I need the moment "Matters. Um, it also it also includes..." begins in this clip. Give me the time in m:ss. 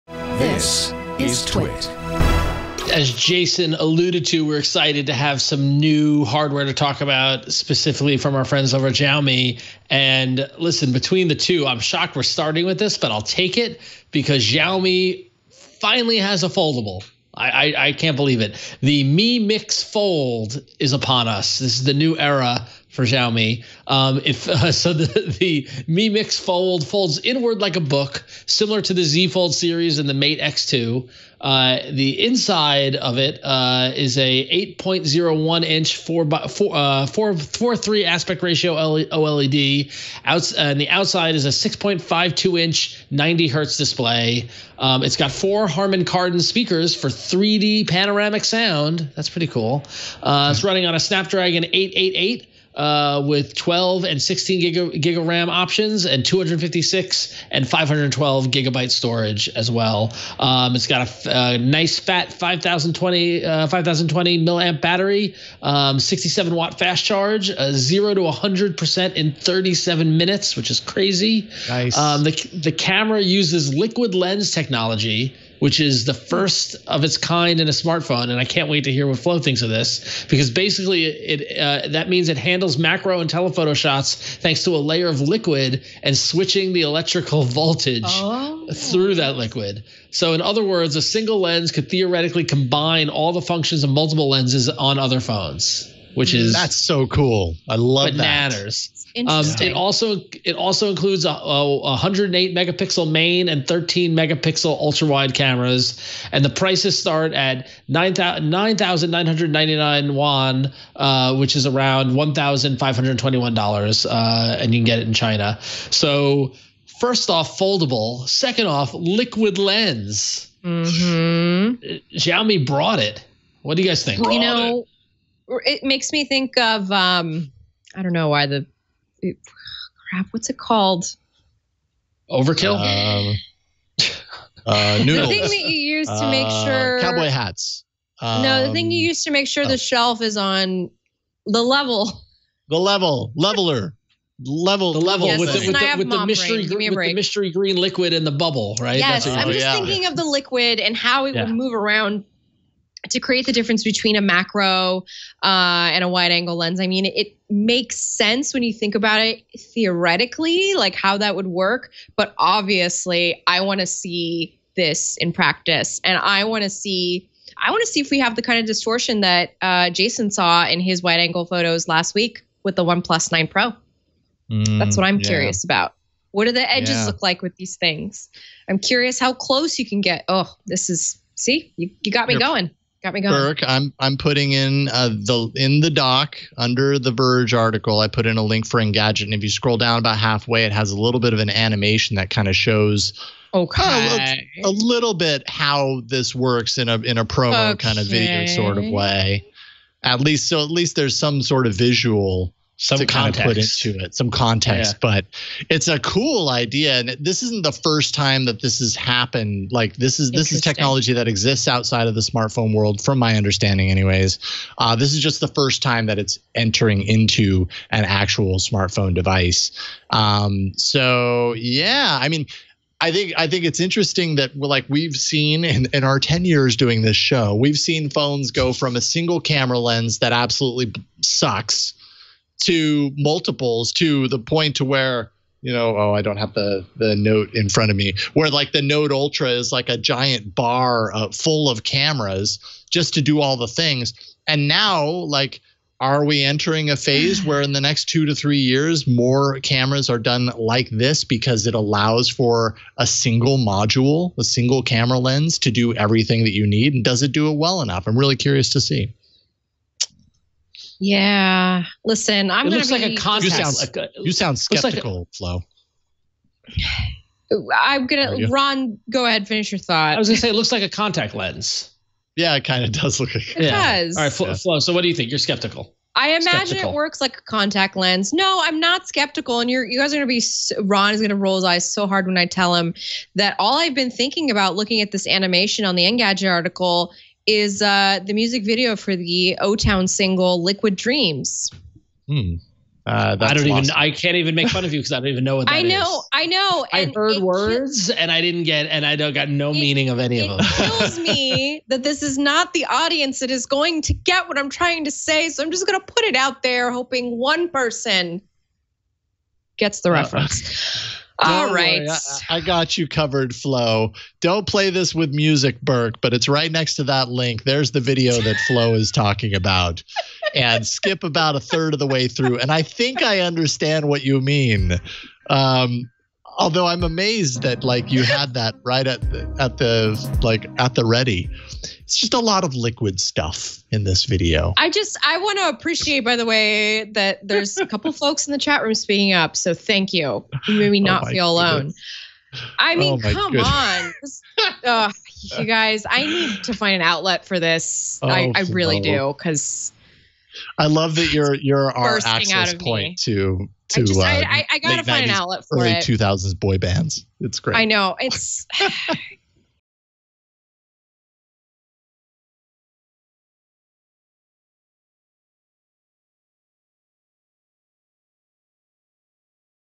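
1:38.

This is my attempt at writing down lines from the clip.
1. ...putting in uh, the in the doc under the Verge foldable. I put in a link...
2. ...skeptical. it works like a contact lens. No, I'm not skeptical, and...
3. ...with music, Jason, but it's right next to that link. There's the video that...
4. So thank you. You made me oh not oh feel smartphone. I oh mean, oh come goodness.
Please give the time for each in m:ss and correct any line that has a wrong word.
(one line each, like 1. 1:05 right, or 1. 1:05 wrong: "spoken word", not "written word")
1. 3:04 wrong: "article", not "foldable"
2. 4:36 right
3. 5:15 wrong: "Burke", not "Jason"
4. 5:39 wrong: "alone", not "smartphone".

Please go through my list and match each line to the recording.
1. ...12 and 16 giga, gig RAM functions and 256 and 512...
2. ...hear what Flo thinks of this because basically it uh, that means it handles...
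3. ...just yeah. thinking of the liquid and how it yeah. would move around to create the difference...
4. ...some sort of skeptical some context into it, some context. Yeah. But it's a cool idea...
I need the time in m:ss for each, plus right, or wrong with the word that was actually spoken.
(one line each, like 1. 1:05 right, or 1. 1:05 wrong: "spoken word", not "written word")
1. 0:53 wrong: "options", not "functions"
2. 1:18 right
3. 2:29 right
4. 3:21 wrong: "visual", not "skeptical".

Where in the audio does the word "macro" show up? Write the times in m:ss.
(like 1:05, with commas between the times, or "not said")
1:22, 2:34.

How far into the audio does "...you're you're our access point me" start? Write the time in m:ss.
5:51.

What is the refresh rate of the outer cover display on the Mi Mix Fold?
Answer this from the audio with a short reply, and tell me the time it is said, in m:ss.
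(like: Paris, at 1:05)
90 hertz, at 0:43.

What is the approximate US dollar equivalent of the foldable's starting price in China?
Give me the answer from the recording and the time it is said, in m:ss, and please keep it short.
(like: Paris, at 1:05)
$1,521, at 1:52.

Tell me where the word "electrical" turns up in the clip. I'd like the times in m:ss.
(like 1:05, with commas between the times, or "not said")
1:26.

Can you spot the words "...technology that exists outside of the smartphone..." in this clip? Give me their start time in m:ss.
3:30.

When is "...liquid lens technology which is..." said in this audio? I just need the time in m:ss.
1:13.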